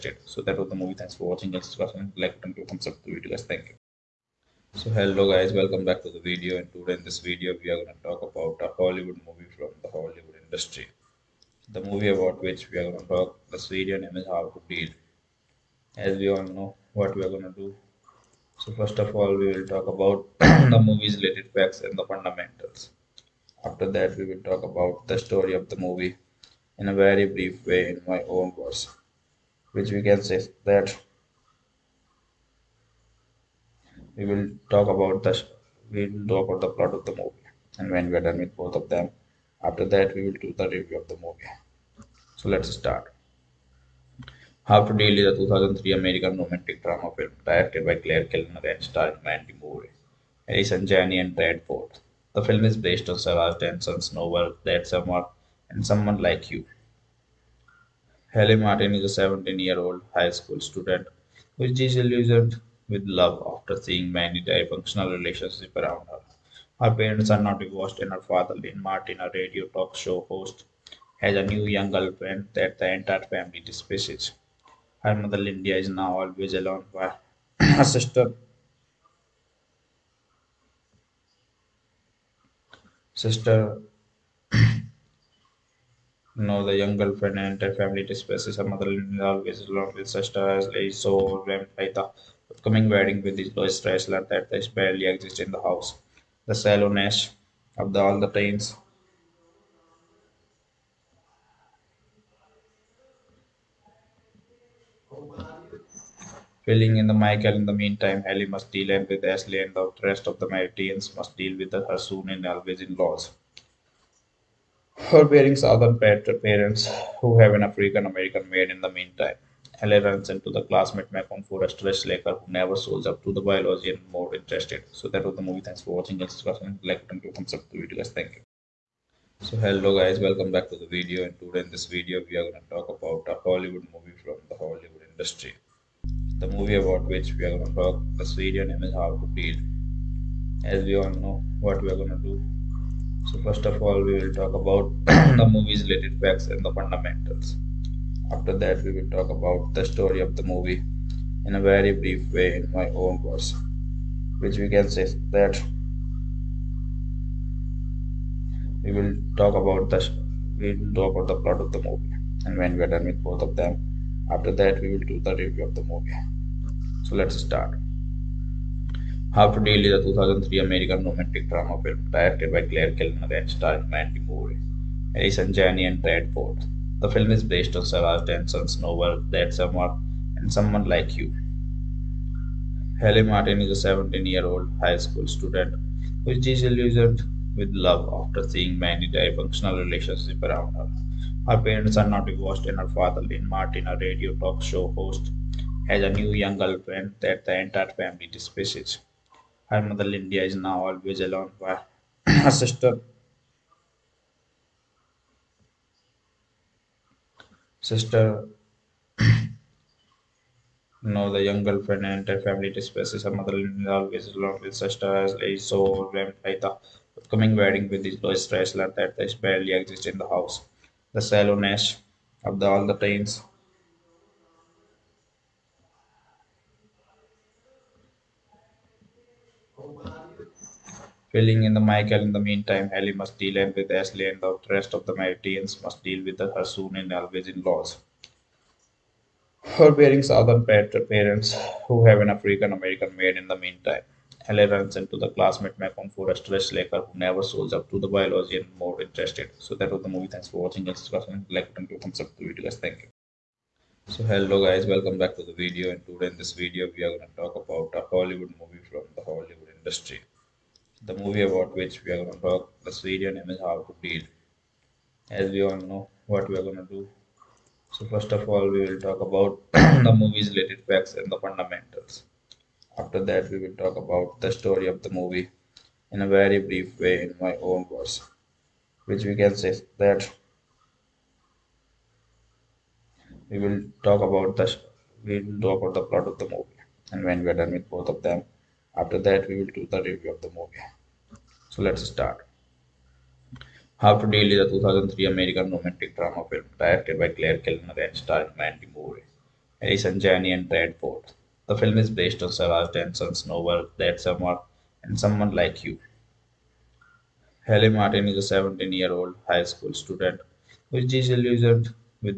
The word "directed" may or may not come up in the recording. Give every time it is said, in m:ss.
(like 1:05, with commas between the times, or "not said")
0:47, 2:52, 4:56.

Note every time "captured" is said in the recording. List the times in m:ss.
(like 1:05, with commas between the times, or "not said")
not said.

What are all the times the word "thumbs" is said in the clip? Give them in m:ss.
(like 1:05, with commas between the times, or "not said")
0:02, 2:07, 4:12.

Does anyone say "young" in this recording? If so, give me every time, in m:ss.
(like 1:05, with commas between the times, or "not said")
1:11, 1:26, 3:16, 3:31.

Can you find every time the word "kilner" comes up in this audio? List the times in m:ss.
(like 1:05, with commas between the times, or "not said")
0:48, 2:52, 4:57.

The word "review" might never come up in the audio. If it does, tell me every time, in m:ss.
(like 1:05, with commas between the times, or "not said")
0:40, 2:45, 4:50.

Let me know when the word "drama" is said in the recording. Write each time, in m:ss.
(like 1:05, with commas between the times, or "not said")
0:46, 2:51, 4:56.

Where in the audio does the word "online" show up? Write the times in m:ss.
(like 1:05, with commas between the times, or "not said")
not said.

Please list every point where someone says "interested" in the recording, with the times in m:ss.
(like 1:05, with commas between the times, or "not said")
2:04, 4:09.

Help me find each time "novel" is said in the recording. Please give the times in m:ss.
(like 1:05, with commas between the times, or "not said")
0:54, 2:58, 5:03.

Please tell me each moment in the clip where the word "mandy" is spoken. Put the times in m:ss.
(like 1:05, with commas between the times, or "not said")
0:49, 2:53, 4:58.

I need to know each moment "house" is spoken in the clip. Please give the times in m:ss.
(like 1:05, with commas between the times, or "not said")
1:35, 3:40.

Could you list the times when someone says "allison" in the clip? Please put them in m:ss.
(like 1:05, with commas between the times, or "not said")
0:50, 2:55, 4:59.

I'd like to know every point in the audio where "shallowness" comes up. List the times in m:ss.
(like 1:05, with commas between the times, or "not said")
1:36, 3:41.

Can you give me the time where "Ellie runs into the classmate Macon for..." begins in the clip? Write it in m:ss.
4:04.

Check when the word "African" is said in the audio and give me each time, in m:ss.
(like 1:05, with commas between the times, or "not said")
1:57, 4:02.